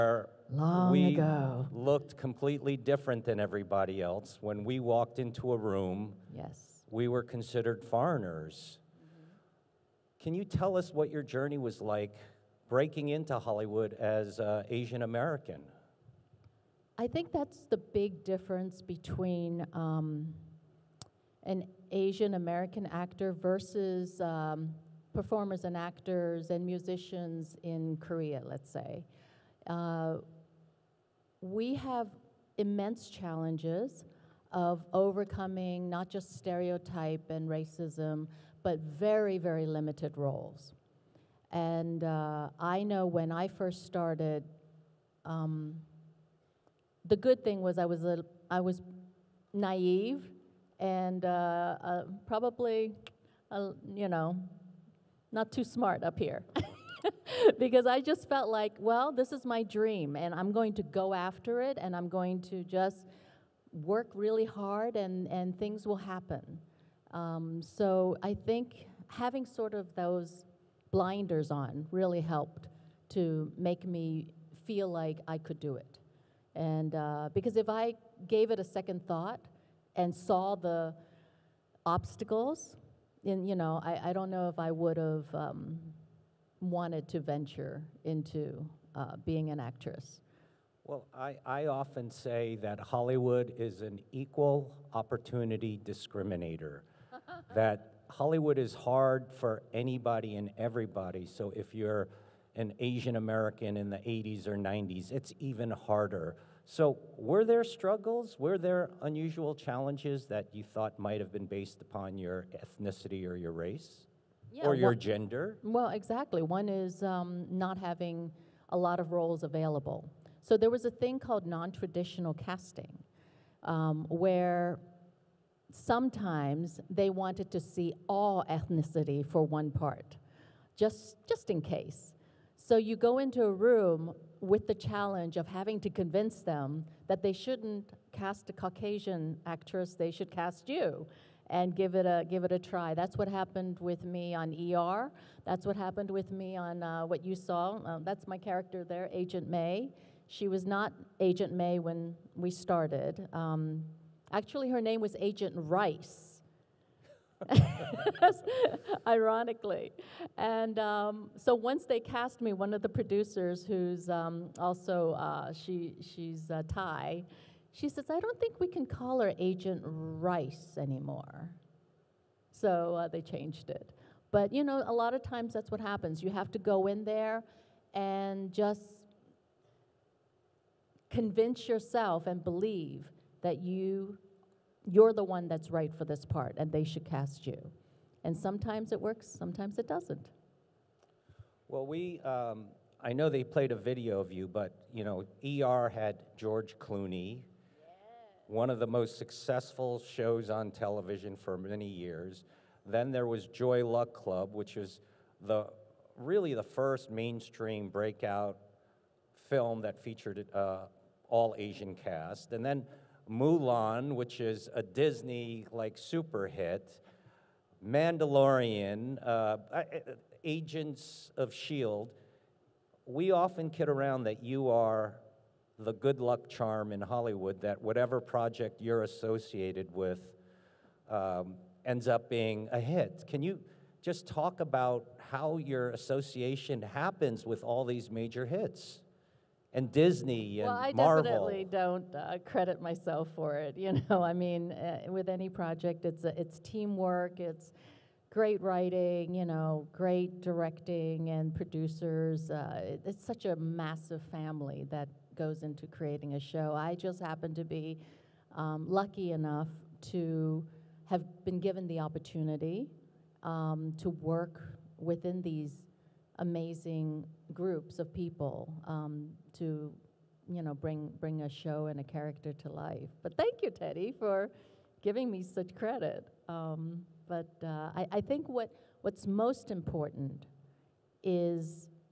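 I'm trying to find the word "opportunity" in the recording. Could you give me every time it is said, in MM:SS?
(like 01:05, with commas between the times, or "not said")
01:34, 04:21.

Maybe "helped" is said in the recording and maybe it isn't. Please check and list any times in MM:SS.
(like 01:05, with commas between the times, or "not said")
01:12.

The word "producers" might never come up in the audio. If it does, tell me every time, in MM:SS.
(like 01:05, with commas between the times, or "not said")
02:42, 04:11.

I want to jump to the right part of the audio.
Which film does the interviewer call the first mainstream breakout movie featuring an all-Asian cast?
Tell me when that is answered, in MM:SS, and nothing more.
03:23.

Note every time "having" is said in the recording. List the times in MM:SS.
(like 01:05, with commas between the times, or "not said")
01:09, 01:57, 02:15.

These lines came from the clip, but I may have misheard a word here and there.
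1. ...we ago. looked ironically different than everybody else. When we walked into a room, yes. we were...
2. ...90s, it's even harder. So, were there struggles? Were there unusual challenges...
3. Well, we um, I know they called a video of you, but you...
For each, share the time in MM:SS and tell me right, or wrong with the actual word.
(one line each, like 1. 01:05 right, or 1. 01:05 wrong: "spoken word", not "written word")
1. 00:00 wrong: "completely", not "ironically"
2. 01:44 right
3. 03:11 wrong: "played", not "called".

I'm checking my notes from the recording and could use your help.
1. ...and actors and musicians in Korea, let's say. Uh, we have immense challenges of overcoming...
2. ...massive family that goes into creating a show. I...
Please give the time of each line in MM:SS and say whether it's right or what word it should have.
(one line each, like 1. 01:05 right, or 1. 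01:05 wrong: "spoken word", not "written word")
1. 00:25 right
2. 04:13 right.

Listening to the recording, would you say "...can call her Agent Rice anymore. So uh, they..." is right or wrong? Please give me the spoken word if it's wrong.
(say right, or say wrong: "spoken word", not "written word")
right.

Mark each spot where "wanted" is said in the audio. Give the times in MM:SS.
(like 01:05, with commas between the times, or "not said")
01:26, 02:07.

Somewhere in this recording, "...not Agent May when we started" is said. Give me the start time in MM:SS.
02:30.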